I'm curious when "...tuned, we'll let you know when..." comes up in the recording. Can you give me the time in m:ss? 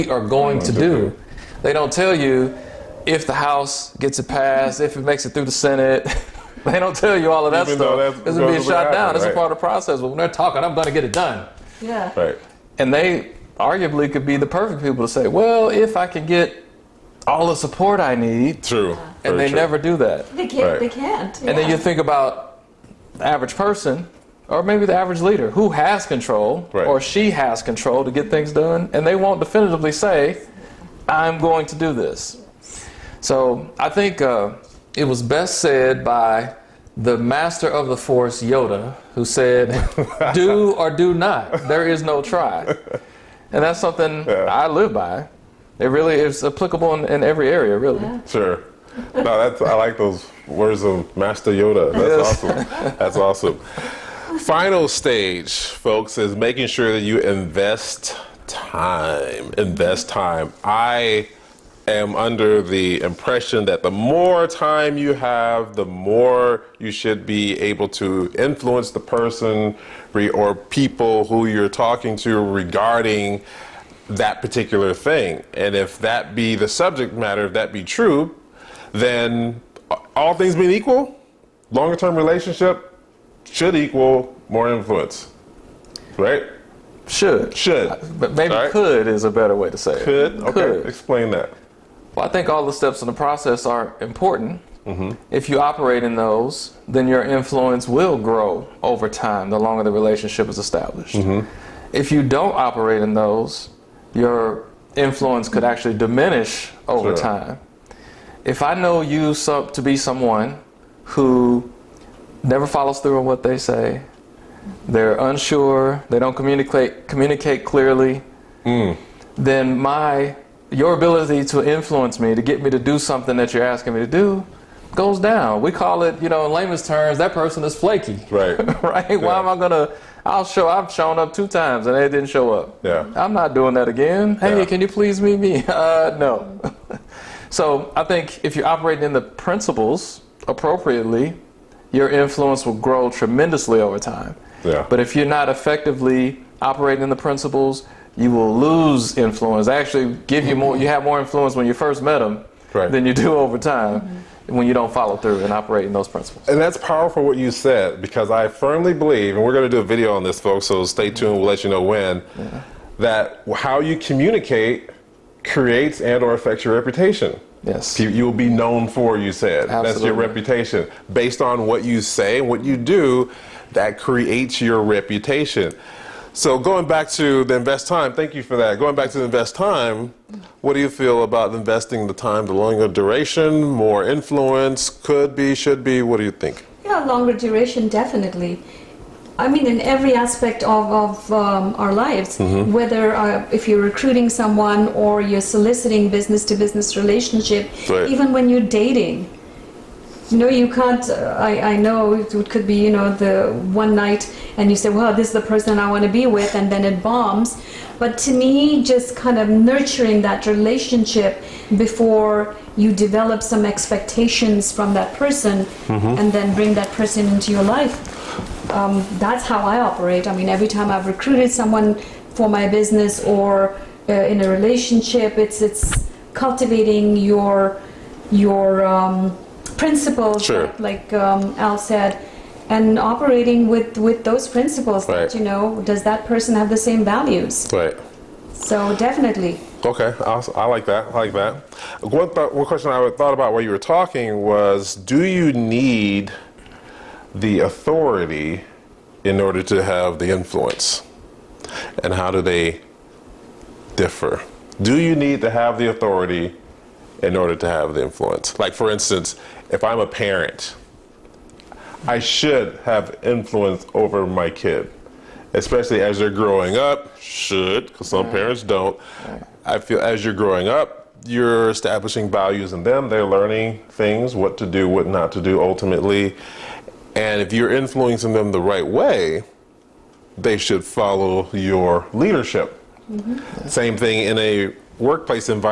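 2:41.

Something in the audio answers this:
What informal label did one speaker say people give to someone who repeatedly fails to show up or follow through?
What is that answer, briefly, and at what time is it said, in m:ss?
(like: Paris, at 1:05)
Flaky, at 2:07.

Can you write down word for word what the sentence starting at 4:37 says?
And if you're influencing them the right way, they should follow your leadership.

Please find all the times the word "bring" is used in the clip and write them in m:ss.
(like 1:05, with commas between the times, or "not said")
3:36.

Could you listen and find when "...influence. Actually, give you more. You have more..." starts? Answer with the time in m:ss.
2:29.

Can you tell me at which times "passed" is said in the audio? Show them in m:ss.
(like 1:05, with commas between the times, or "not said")
0:04.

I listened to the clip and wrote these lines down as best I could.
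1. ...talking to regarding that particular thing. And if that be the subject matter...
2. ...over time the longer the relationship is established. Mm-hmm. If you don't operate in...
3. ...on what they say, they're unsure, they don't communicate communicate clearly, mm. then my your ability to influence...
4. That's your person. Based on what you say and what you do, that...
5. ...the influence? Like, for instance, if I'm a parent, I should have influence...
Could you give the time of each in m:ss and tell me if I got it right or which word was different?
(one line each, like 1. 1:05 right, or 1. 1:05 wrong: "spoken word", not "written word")
1. 1:11 right
2. 1:38 right
3. 1:53 right
4. 2:49 wrong: "reputation", not "person"
5. 4:17 right.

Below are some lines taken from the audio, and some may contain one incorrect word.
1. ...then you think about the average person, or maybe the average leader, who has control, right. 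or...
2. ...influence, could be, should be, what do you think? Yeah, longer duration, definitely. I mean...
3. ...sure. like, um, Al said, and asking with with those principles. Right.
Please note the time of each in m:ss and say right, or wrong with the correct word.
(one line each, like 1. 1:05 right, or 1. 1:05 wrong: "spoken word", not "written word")
1. 0:21 right
2. 3:04 right
3. 3:50 wrong: "operating", not "asking".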